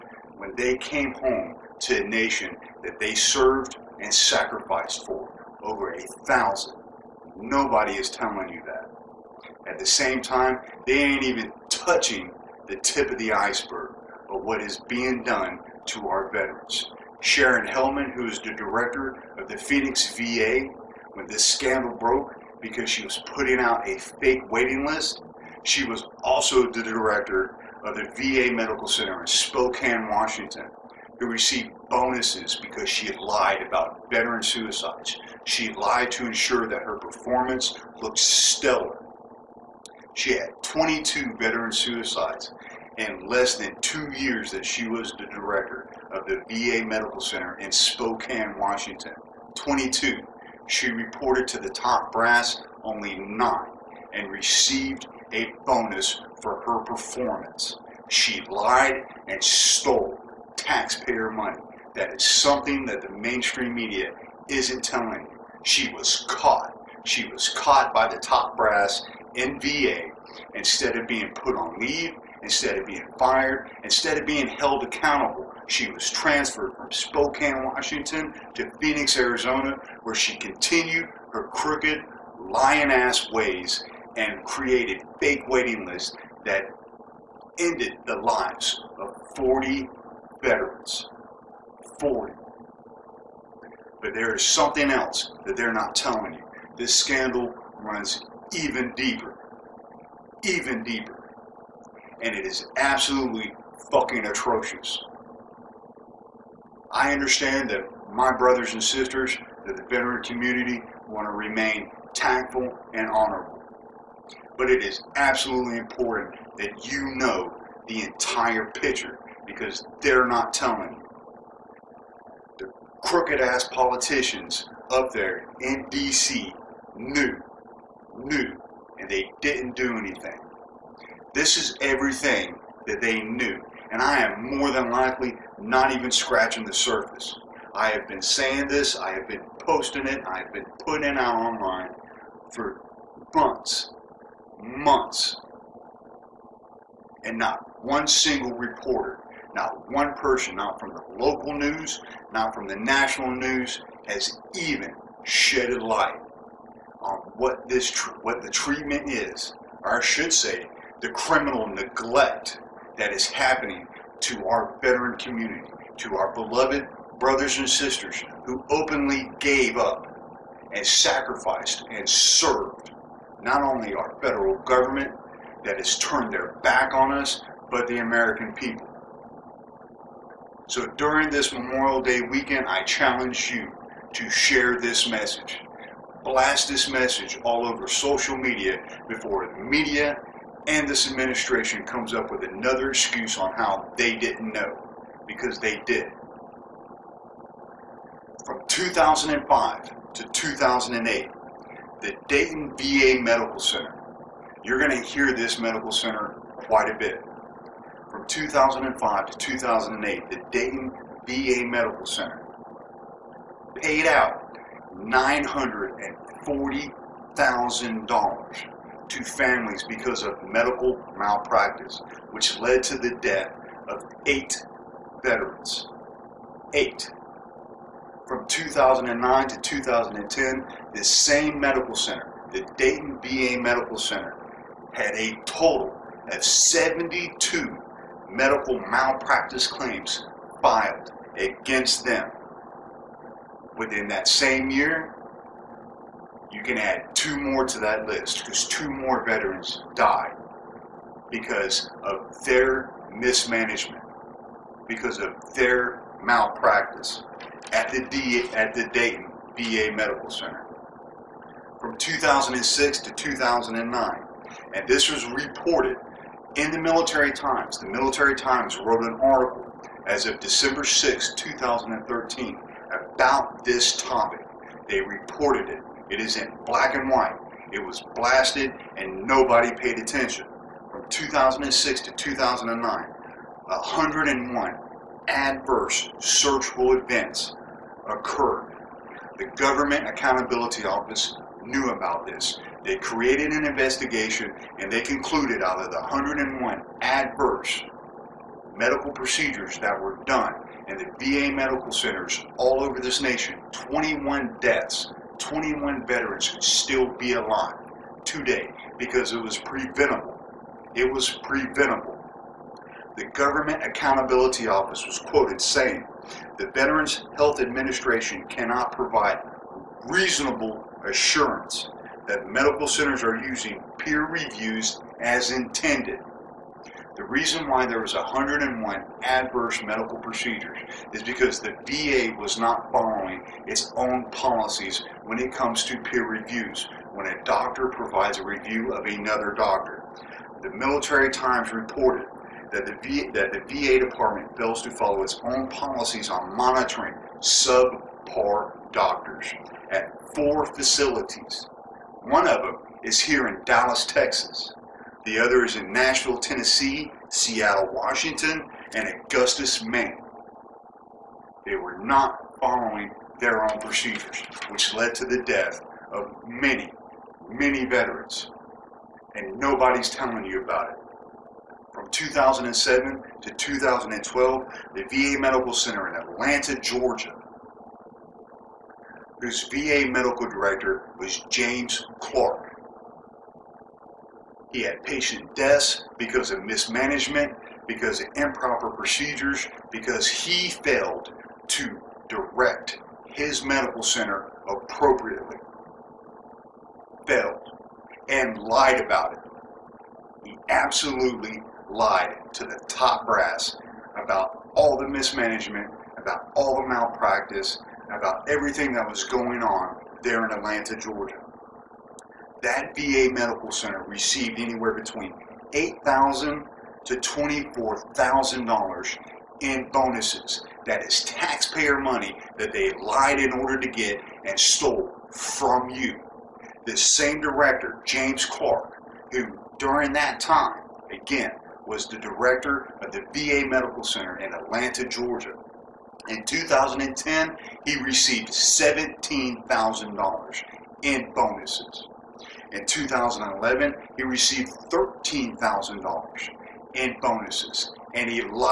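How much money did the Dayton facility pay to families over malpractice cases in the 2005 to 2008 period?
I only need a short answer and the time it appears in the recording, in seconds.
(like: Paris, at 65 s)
$940,000, at 215 s.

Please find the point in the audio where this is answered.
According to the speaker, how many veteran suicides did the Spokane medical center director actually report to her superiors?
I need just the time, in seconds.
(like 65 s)
52 s.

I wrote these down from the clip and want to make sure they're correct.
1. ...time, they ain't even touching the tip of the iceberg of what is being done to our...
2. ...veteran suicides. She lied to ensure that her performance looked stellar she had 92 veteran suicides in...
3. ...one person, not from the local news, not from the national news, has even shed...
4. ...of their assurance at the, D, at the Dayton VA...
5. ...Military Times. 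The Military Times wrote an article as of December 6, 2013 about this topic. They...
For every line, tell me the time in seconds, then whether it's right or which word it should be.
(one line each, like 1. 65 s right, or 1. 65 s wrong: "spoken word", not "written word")
1. 10 s right
2. 34 s wrong: "22", not "92"
3. 149 s right
4. 255 s wrong: "malpractice", not "assurance"
5. 266 s right.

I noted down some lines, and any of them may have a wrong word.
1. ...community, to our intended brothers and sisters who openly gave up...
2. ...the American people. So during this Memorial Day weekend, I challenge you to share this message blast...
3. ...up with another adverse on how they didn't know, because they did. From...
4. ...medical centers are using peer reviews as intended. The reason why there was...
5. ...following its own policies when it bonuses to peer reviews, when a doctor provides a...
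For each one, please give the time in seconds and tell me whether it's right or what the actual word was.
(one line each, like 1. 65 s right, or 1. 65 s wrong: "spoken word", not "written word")
1. 165 s wrong: "beloved", not "intended"
2. 177 s right
3. 192 s wrong: "excuse", not "adverse"
4. 322 s right
5. 332 s wrong: "comes", not "bonuses".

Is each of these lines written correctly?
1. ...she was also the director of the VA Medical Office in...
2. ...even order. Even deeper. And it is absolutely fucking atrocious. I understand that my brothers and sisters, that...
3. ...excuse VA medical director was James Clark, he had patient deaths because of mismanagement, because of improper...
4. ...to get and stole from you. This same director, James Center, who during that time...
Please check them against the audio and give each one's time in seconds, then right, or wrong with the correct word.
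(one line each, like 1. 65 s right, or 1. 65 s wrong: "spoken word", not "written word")
1. 25 s wrong: "Center", not "Office"
2. 98 s wrong: "deeper", not "order"
3. 379 s wrong: "whose", not "excuse"
4. 423 s wrong: "Clark", not "Center".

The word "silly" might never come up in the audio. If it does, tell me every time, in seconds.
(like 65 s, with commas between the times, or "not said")
not said.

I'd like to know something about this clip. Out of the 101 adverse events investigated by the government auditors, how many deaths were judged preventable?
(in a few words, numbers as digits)
21.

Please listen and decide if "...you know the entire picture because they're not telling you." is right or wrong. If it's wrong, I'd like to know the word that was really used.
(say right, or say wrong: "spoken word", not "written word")
right.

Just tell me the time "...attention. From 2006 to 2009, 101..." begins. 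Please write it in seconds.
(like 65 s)
279 s.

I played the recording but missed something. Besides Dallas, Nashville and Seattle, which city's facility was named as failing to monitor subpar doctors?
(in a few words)
Augusta, Maine.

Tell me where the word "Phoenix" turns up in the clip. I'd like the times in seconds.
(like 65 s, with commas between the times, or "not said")
19 s, 78 s.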